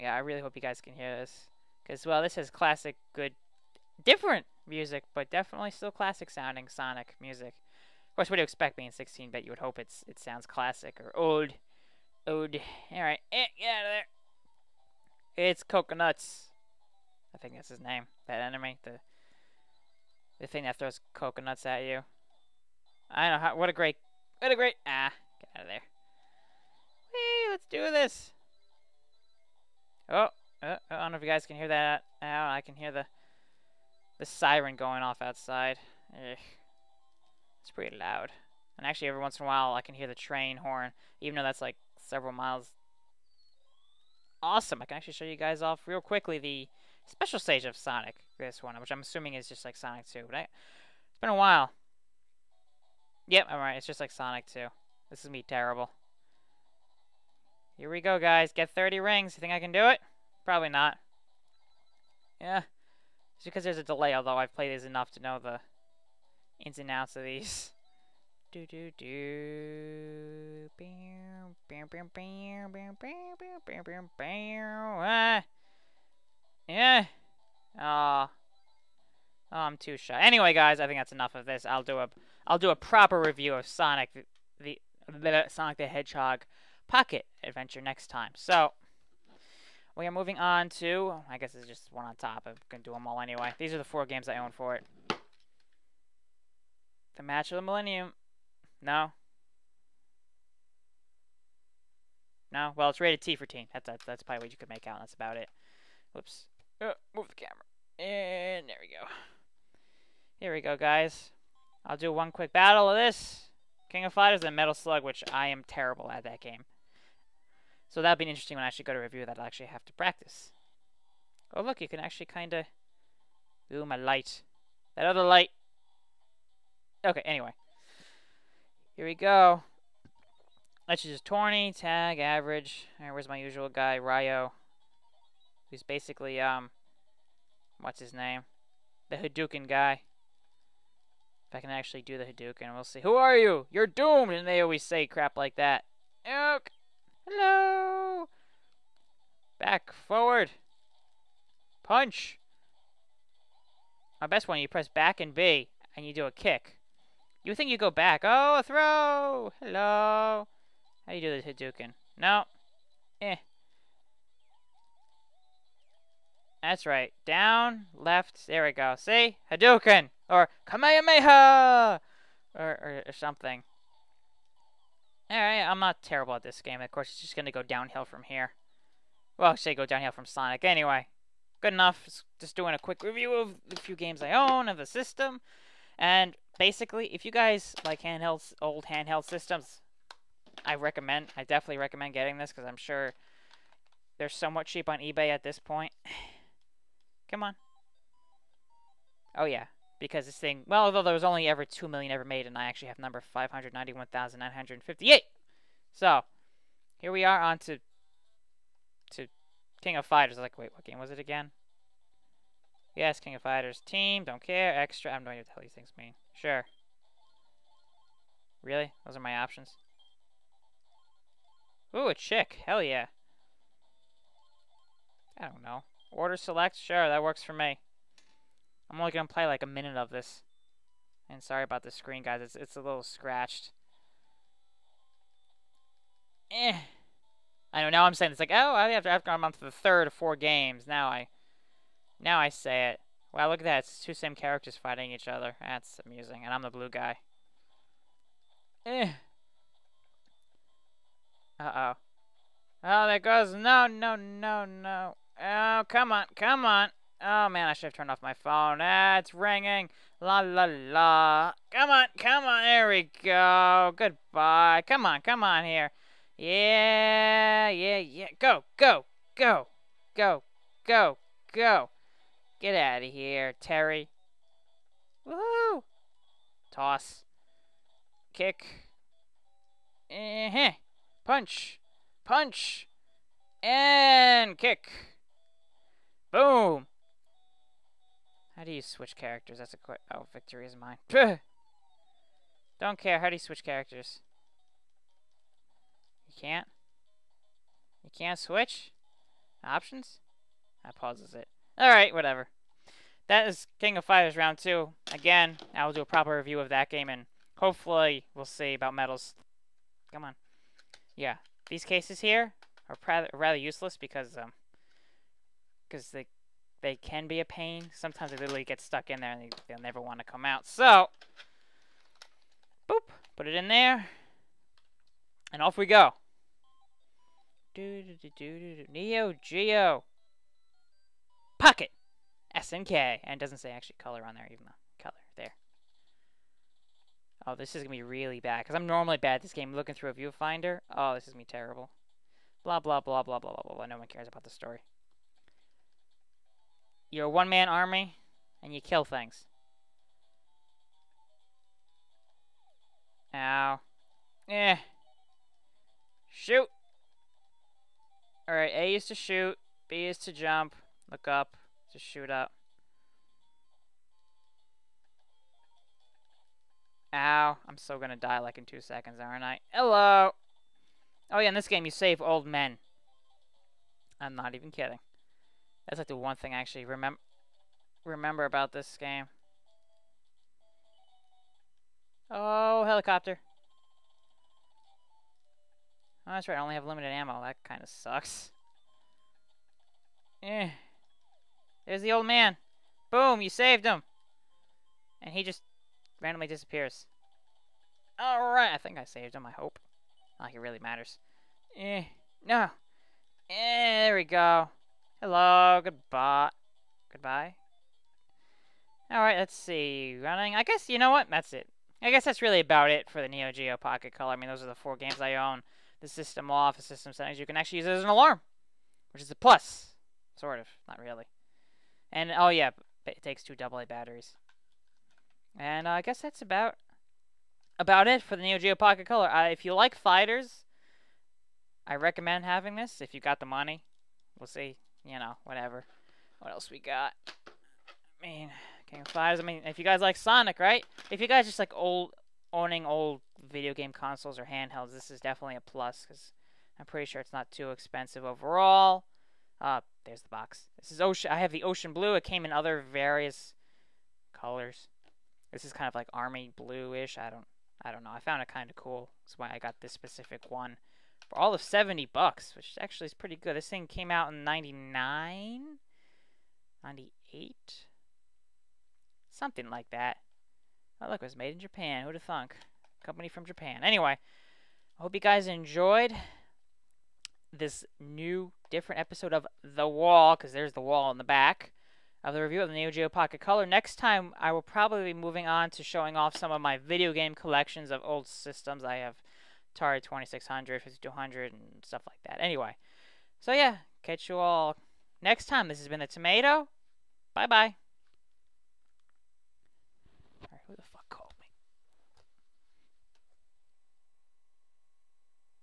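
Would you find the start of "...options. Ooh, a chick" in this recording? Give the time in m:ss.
3:39.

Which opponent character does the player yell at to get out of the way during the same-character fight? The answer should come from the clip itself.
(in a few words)
Terry.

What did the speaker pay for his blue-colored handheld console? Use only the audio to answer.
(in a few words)
70 bucks.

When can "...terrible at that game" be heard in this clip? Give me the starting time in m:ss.
1:55.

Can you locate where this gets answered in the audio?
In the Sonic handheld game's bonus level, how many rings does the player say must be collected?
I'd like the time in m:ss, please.
0:58.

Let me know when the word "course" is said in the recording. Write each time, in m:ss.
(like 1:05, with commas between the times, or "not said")
0:08, 2:56.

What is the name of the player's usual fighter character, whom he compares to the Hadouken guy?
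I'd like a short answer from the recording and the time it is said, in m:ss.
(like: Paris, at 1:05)
Ryo, at 2:13.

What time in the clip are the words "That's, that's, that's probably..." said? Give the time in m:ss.
1:43.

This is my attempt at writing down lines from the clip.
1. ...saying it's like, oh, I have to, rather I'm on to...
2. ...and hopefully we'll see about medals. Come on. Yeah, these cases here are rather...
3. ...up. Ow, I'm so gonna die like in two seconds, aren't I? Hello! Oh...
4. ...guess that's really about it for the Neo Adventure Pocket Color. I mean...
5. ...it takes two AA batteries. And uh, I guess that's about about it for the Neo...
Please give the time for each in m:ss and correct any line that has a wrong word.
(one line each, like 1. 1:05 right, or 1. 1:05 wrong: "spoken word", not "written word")
1. 3:58 wrong: "after", not "rather"
2. 5:07 right
3. 6:02 right
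4. 6:52 wrong: "Geo", not "Adventure"
5. 7:03 right.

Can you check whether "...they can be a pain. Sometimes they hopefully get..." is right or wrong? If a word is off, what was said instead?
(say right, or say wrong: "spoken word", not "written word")
wrong: "literally", not "hopefully".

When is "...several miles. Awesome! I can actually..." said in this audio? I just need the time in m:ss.
0:41.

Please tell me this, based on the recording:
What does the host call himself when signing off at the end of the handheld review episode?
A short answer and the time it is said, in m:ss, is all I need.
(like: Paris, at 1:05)
The Tomato, at 8:15.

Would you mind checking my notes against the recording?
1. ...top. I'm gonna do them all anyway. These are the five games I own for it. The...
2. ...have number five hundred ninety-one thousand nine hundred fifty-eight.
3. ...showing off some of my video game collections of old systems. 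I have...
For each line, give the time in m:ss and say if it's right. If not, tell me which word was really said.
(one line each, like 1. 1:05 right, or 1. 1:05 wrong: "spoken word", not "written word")
1. 1:32 wrong: "four", not "five"
2. 3:22 right
3. 8:05 right.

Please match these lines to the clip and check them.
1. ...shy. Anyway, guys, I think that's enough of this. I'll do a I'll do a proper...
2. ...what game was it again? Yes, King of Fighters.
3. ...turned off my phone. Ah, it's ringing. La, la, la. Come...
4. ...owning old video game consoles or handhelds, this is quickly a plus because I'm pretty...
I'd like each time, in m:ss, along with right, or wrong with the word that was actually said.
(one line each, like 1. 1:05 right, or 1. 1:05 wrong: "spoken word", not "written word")
1. 1:19 right
2. 3:30 right
3. 4:17 right
4. 7:22 wrong: "definitely", not "quickly".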